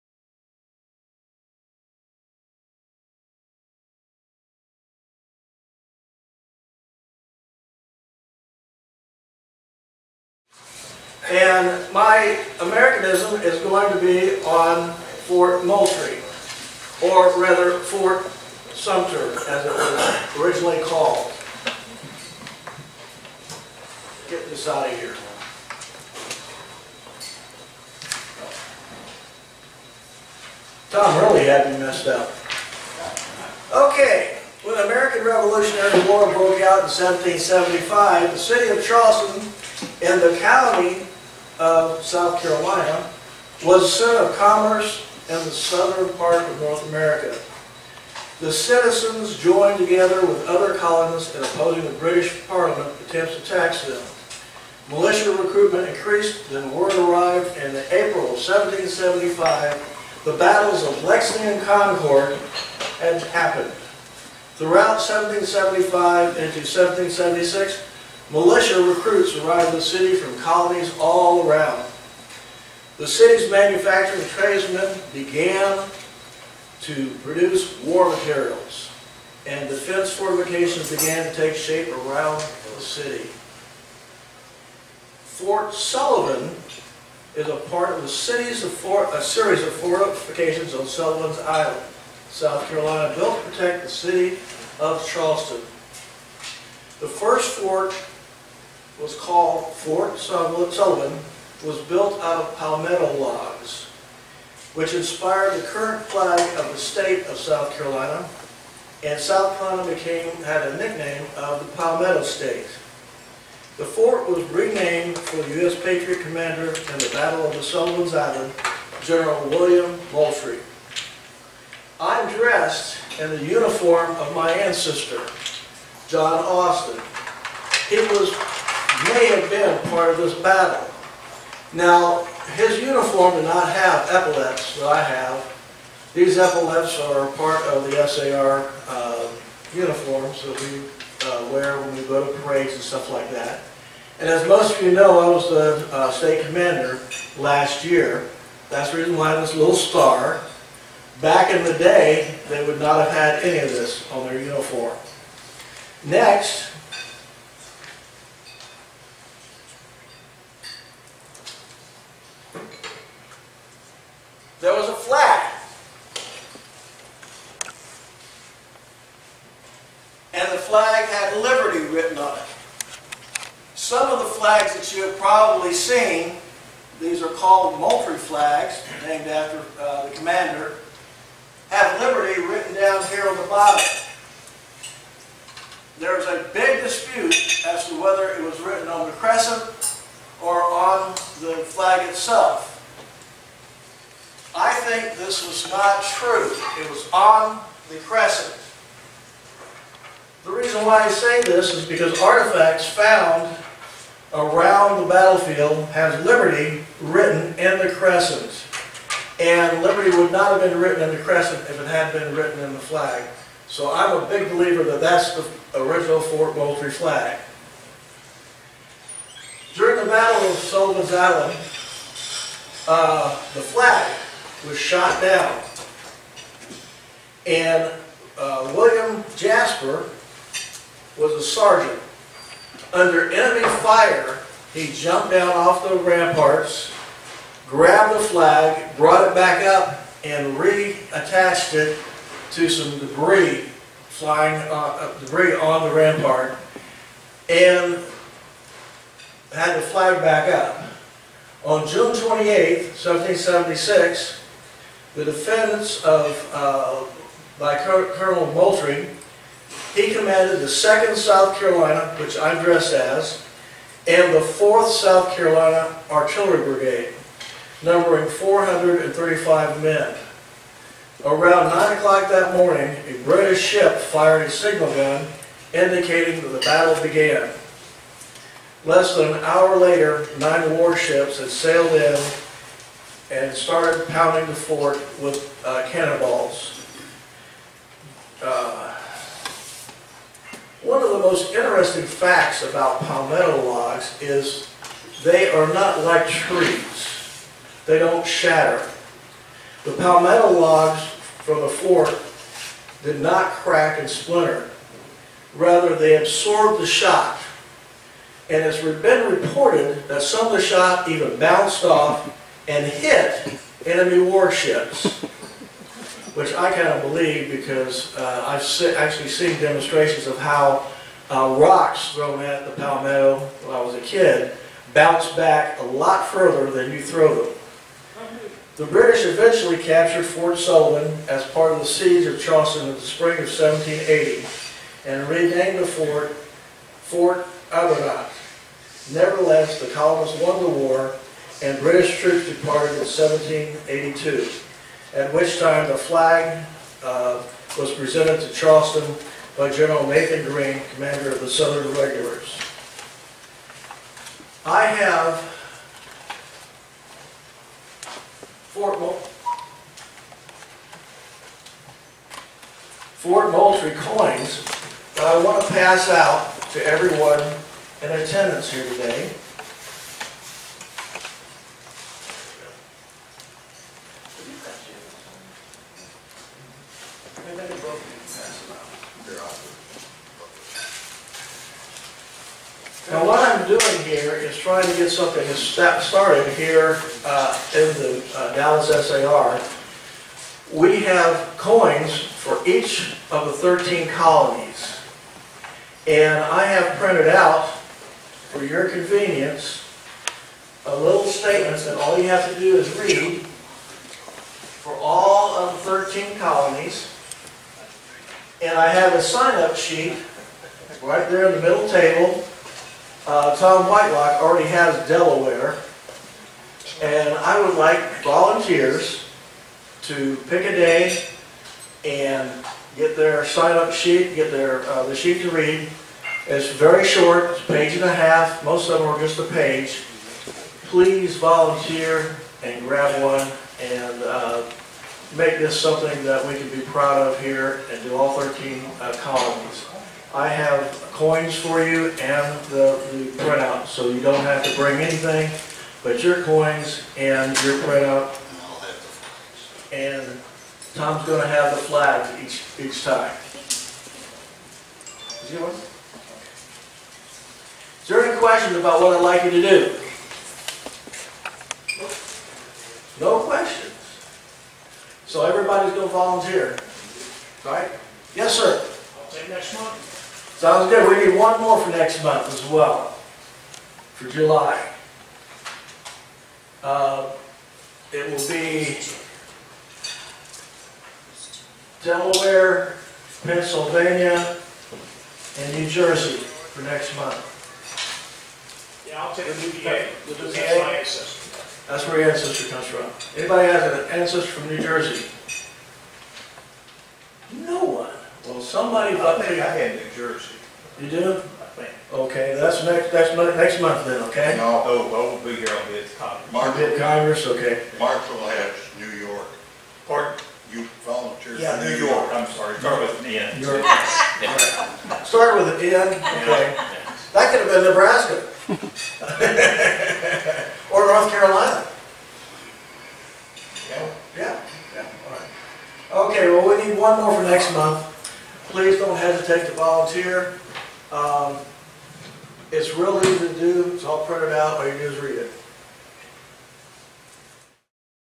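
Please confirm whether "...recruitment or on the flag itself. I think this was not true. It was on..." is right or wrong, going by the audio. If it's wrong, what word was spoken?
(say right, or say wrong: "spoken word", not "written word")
wrong: "crescent", not "recruitment".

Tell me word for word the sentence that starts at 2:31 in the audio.
Back in the day, they would not have had any of this on their uniform.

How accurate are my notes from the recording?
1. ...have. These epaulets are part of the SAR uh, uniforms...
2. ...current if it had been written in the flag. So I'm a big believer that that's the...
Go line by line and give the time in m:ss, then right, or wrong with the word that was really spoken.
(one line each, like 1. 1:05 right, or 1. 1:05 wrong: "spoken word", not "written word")
1. 2:15 right
2. 3:31 wrong: "crescent", not "current".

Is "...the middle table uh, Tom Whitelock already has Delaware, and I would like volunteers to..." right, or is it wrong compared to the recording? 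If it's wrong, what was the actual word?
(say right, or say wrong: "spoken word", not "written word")
right.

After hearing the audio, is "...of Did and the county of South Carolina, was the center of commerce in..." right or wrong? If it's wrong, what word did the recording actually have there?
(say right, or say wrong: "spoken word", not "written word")
wrong: "Charleston", not "Did".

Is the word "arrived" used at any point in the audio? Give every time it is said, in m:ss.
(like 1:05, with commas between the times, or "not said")
0:56, 1:09.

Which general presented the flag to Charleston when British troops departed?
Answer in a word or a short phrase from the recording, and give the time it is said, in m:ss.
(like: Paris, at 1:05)
Nathan Greene, at 5:50.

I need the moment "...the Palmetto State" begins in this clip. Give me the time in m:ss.
1:51.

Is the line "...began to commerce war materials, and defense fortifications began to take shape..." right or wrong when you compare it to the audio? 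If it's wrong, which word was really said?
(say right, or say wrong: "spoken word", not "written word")
wrong: "produce", not "commerce".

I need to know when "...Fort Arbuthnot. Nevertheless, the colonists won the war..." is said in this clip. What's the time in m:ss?
5:37.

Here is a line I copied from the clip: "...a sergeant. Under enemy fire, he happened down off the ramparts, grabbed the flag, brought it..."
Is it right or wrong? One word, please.
wrong.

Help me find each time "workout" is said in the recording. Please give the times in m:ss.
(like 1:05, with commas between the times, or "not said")
not said.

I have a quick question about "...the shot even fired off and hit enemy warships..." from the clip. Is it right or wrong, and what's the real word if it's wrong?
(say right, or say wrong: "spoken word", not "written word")
wrong: "bounced", not "fired".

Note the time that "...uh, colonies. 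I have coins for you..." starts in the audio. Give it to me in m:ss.
7:18.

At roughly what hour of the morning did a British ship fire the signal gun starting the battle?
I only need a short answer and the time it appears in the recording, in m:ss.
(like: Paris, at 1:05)
9 o'clock, at 4:31.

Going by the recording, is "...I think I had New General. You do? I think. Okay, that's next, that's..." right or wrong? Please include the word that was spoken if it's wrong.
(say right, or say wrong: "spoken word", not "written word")
wrong: "Jersey", not "General".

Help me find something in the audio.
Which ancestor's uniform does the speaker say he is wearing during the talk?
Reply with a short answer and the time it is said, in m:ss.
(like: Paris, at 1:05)
John Austin, at 2:06.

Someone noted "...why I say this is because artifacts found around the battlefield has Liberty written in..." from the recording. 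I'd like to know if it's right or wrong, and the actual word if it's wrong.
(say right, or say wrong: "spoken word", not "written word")
right.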